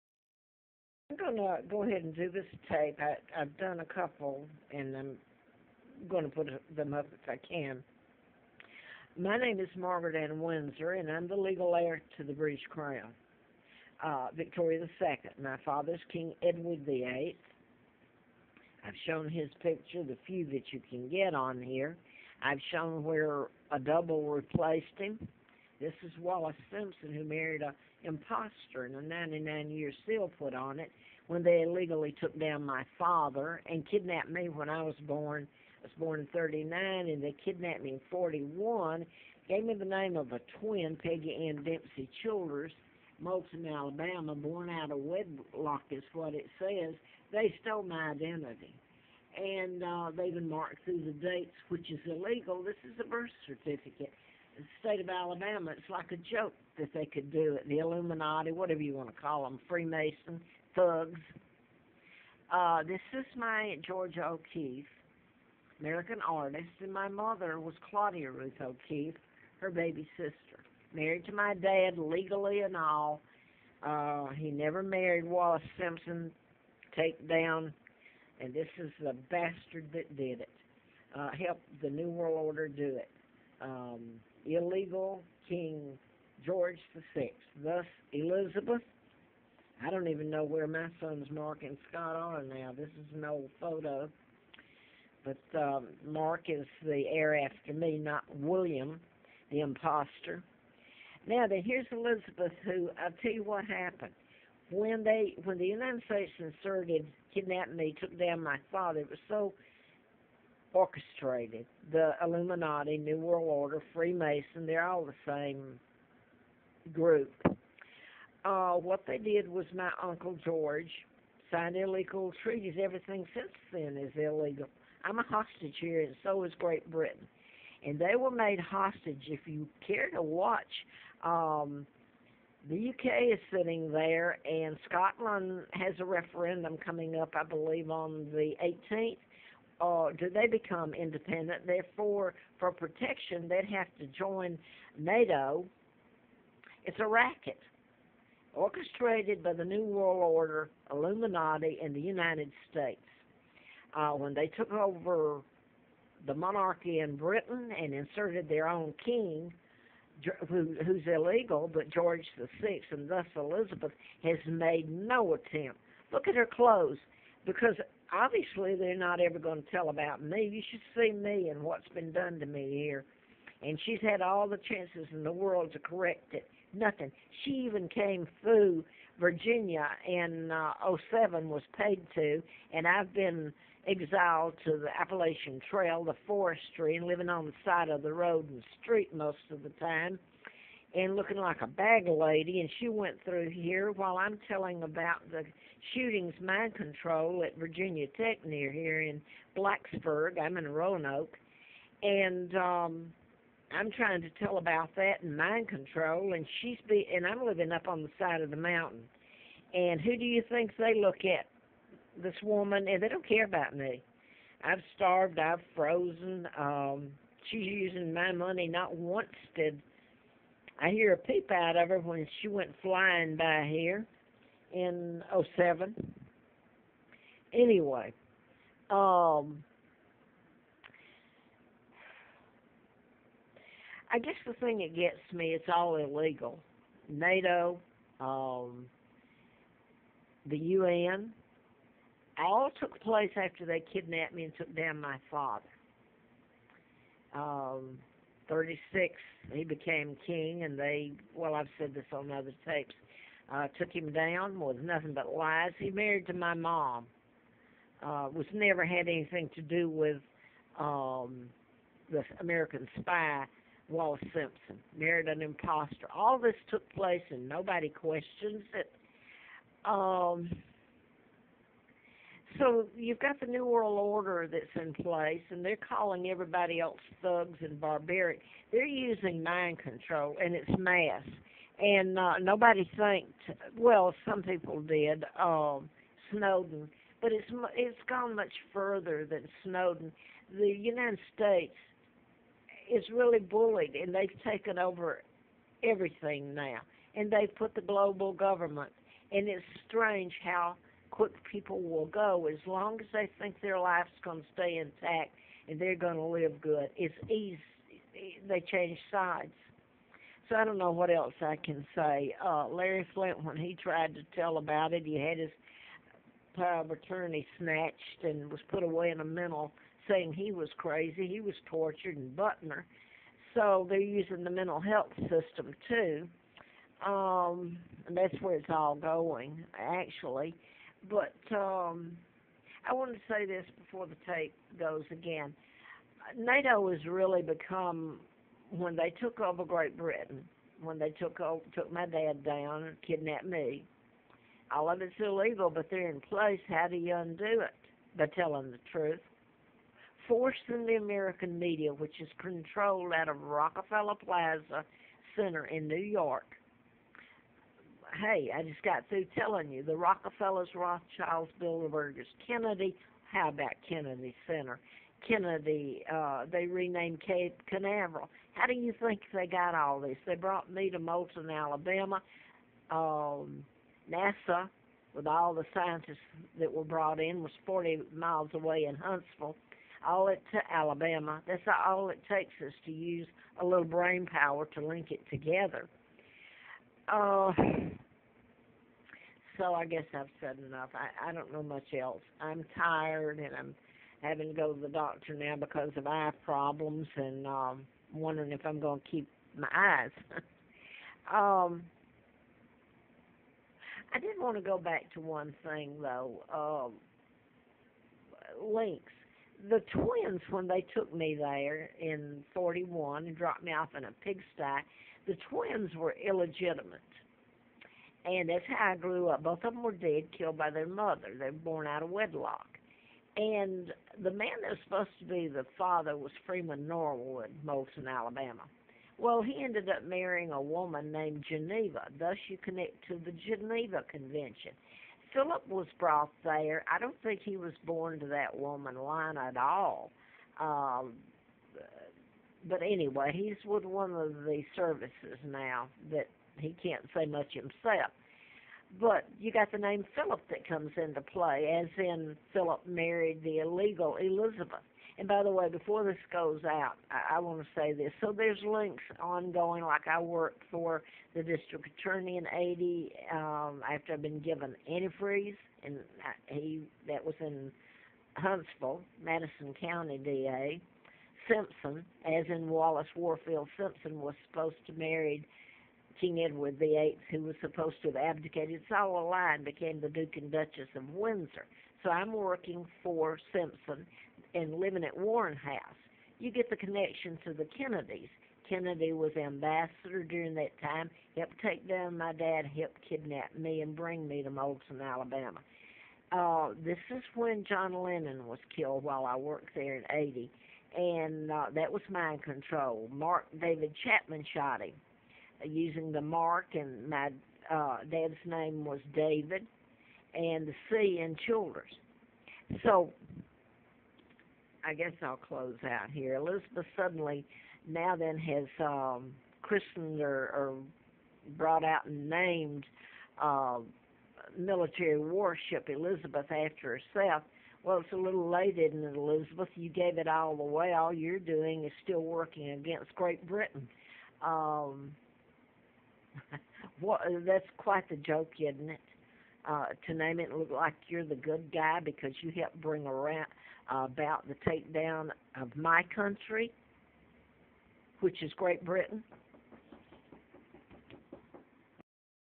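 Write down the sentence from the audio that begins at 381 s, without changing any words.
That's all it takes us to use a little brain power to link it together.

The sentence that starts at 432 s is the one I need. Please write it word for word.
Thus, you connect to the Geneva Convention.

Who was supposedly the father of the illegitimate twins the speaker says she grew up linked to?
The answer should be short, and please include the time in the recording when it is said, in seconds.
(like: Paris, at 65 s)
Freeman Norwood, at 426 s.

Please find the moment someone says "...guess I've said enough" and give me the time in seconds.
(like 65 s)
389 s.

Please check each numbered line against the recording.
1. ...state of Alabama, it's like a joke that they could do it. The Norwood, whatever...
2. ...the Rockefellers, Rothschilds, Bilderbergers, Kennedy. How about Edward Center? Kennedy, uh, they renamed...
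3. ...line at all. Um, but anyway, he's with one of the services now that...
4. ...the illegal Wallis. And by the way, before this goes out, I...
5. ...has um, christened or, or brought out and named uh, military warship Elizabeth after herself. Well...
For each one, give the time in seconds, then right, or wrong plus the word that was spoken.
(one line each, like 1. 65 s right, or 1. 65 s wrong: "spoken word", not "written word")
1. 54 s wrong: "Illuminati", not "Norwood"
2. 359 s wrong: "Kennedy", not "Edward"
3. 438 s right
4. 453 s wrong: "Elizabeth", not "Wallis"
5. 518 s right.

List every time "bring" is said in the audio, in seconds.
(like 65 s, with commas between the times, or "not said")
493 s, 542 s.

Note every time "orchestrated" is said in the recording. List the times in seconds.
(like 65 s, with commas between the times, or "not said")
110 s, 148 s.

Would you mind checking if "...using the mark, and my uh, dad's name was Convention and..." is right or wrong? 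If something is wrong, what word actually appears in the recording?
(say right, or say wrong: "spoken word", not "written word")
wrong: "David", not "Convention".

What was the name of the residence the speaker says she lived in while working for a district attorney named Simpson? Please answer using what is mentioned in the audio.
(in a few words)
Warren House.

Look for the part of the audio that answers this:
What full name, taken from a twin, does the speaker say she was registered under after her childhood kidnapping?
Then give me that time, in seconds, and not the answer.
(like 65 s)
41 s.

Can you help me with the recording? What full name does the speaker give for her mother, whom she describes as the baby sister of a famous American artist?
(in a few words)
Claudia Ruth O'Keeffe.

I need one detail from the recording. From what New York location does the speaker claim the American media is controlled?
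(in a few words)
Rockefeller Plaza Center.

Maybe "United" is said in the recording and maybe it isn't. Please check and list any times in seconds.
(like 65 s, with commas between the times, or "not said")
105 s, 152 s, 290 s.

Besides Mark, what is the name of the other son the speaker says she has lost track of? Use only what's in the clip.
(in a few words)
Scott.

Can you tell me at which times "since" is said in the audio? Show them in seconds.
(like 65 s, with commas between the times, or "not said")
123 s.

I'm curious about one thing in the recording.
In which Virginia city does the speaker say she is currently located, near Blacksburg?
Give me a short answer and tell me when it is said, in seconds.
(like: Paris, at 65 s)
Roanoke, at 200 s.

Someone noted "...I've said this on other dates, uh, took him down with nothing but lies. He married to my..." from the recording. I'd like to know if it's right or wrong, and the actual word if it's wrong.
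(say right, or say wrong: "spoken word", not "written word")
wrong: "tapes", not "dates".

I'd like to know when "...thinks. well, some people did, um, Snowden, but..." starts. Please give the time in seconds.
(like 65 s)
282 s.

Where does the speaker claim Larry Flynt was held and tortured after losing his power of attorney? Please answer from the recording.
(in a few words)
Butner.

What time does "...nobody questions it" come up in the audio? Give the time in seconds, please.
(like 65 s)
267 s.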